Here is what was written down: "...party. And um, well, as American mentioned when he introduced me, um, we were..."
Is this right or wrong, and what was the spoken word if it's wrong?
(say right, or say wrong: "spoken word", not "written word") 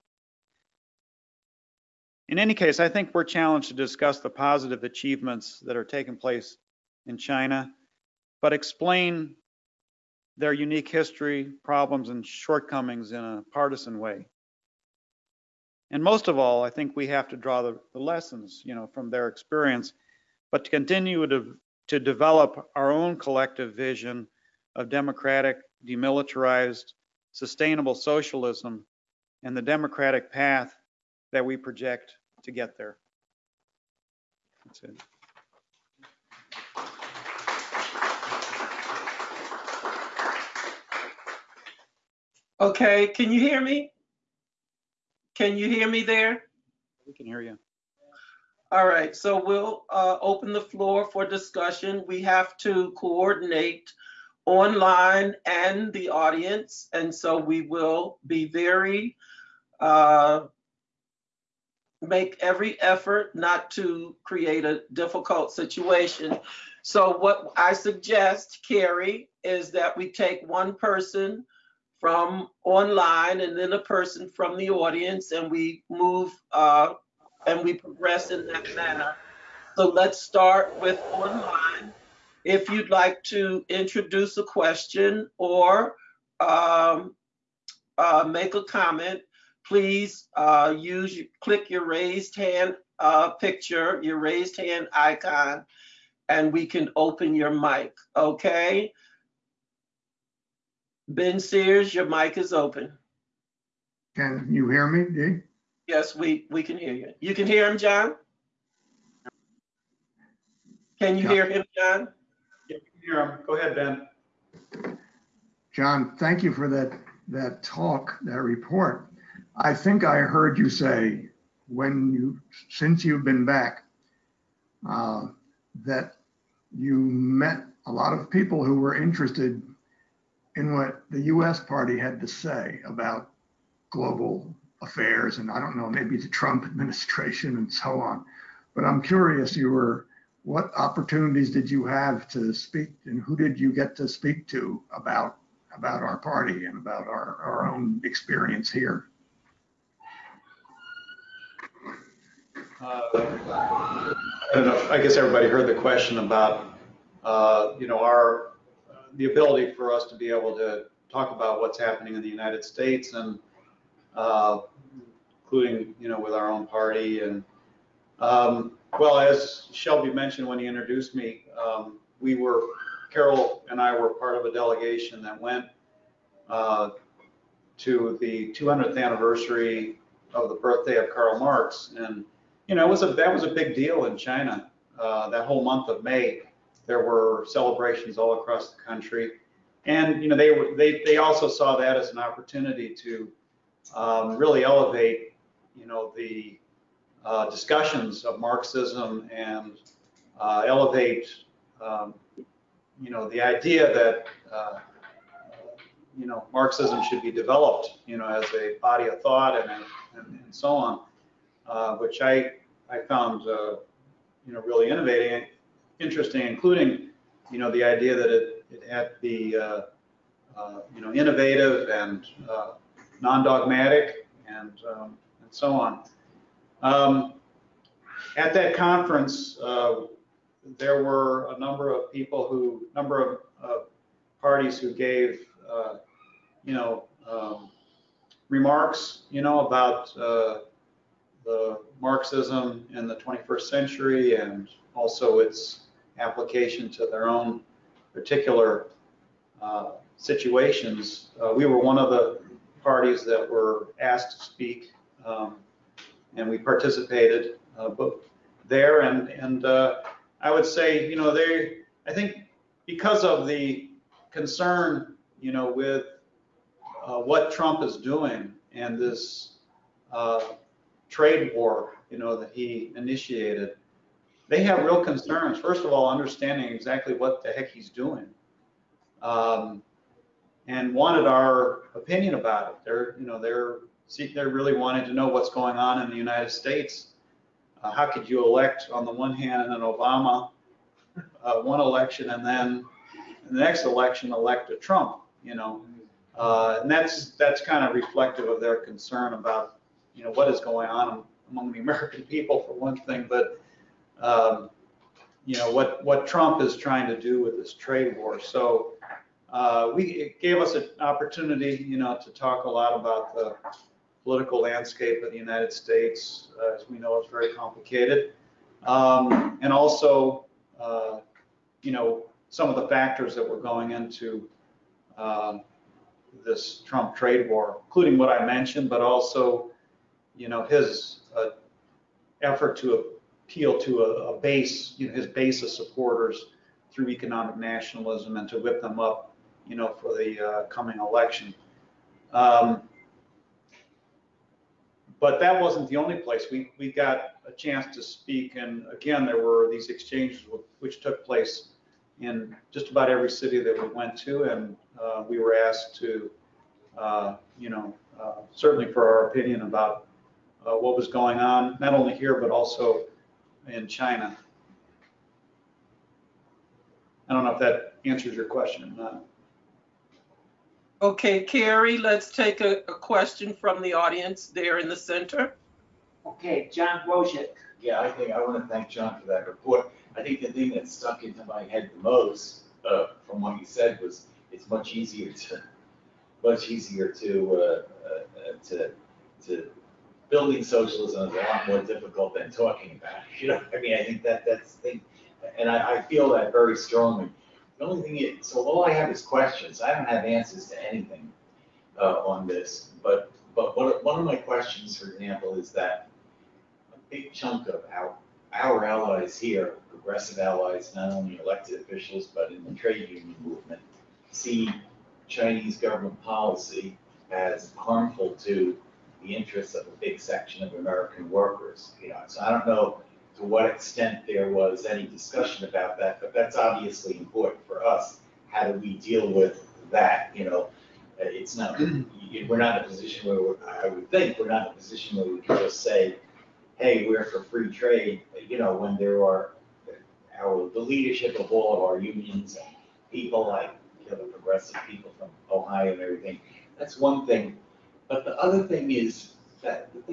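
wrong: "Shelby", not "American".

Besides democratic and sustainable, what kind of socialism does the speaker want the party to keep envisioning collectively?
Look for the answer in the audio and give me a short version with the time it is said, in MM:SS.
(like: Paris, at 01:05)
demilitarized, at 00:25.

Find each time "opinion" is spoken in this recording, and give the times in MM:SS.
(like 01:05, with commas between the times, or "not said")
04:41, 05:59.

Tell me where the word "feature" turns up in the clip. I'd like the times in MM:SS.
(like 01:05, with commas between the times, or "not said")
not said.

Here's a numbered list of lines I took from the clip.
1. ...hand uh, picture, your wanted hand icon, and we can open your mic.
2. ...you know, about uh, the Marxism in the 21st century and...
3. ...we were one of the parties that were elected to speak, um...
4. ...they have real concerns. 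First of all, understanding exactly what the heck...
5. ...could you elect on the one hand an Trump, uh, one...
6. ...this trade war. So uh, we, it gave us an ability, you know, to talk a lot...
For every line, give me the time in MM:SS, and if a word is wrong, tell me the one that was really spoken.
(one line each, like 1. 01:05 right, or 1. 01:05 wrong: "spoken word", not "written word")
1. 01:32 wrong: "raised", not "wanted"
2. 03:59 right
3. 04:11 wrong: "asked", not "elected"
4. 04:34 right
5. 04:48 wrong: "Obama", not "Trump"
6. 05:07 wrong: "opportunity", not "ability".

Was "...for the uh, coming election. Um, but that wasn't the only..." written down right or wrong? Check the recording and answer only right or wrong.
right.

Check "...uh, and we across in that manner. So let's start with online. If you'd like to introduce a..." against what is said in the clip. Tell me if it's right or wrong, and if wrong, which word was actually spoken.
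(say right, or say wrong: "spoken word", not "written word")
wrong: "progress", not "across".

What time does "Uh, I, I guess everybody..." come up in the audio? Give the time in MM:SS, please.
02:32.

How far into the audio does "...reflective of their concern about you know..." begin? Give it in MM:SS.
04:57.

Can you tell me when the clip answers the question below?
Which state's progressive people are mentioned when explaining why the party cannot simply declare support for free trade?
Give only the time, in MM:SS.
07:25.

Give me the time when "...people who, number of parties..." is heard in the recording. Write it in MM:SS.
03:52.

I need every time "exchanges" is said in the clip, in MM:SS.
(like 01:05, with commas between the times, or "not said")
05:49.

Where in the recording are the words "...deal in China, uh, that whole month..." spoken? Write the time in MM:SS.
03:03.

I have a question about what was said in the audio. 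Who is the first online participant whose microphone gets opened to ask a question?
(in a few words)
Ben Sears.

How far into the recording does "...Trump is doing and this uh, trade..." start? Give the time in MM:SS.
04:27.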